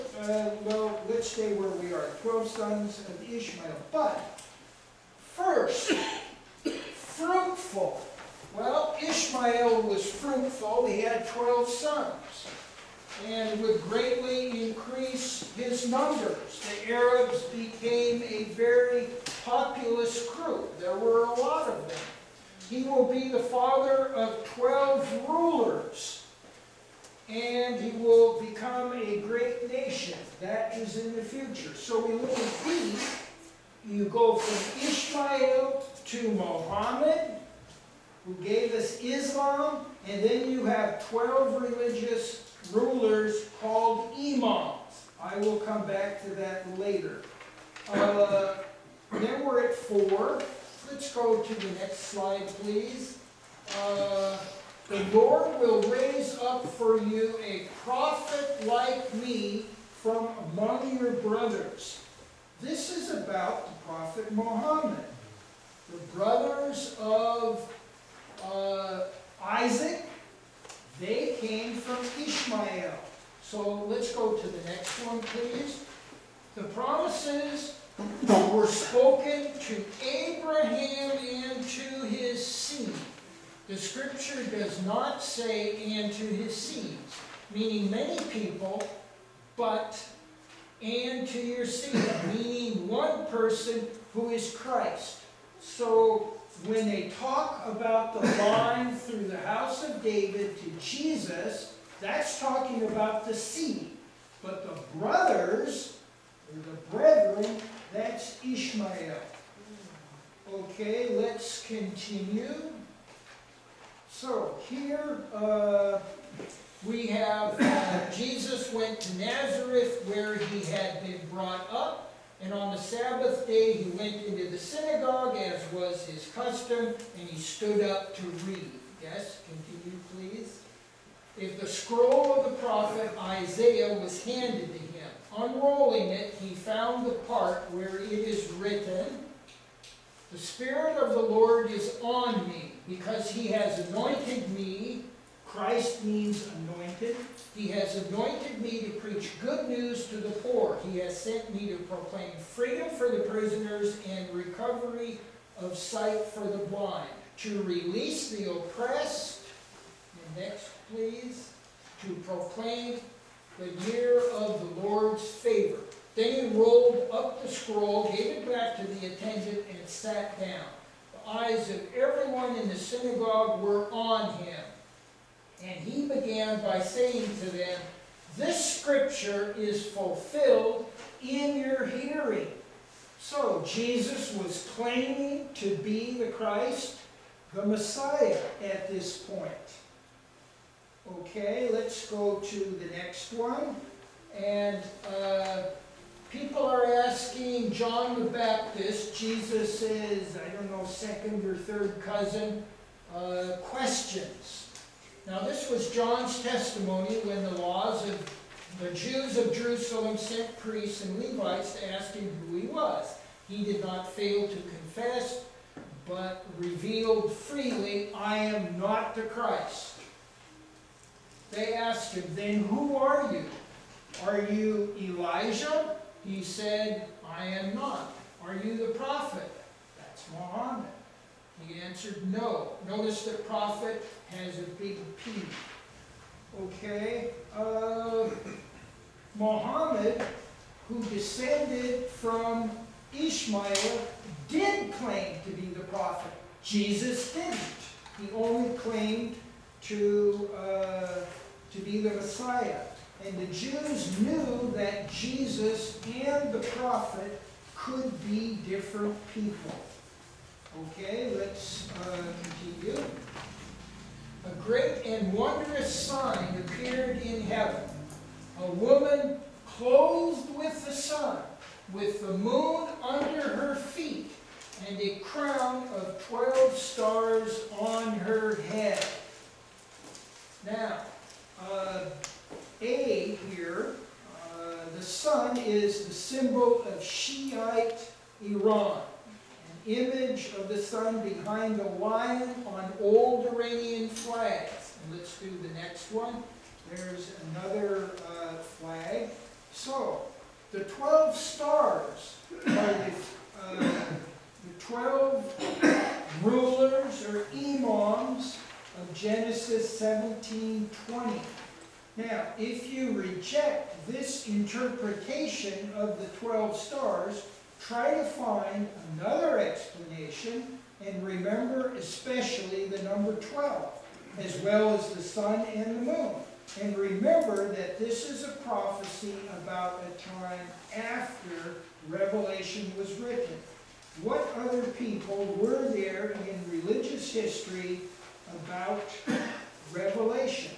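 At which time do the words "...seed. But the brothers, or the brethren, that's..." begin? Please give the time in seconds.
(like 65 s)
103 s.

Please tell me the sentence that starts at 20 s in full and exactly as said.
There were a lot of them.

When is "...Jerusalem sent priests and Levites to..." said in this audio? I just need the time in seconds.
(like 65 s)
209 s.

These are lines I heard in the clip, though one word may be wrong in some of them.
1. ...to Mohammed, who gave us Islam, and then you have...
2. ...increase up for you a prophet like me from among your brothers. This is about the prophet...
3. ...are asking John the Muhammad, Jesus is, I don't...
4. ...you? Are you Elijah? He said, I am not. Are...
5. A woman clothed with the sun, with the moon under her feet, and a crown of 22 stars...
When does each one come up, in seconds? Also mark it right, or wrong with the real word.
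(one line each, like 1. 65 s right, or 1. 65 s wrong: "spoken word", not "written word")
1. 36 s right
2. 55 s wrong: "raise", not "increase"
3. 196 s wrong: "Baptist", not "Muhammad"
4. 223 s right
5. 268 s wrong: "12", not "22".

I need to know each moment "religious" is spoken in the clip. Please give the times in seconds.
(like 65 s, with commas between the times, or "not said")
41 s, 336 s.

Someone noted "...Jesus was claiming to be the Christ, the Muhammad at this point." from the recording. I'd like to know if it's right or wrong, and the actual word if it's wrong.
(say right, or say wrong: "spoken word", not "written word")
wrong: "Messiah", not "Muhammad".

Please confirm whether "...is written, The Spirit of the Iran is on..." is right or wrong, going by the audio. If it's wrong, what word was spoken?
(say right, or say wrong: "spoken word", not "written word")
wrong: "Lord", not "Iran".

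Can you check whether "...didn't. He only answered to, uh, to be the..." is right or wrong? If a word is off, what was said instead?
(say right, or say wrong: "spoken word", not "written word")
wrong: "claimed", not "answered".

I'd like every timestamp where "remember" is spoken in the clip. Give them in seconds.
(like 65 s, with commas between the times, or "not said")
321 s, 326 s.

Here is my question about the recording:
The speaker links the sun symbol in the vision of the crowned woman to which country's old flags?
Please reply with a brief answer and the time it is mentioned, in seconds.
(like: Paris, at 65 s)
Iran, at 287 s.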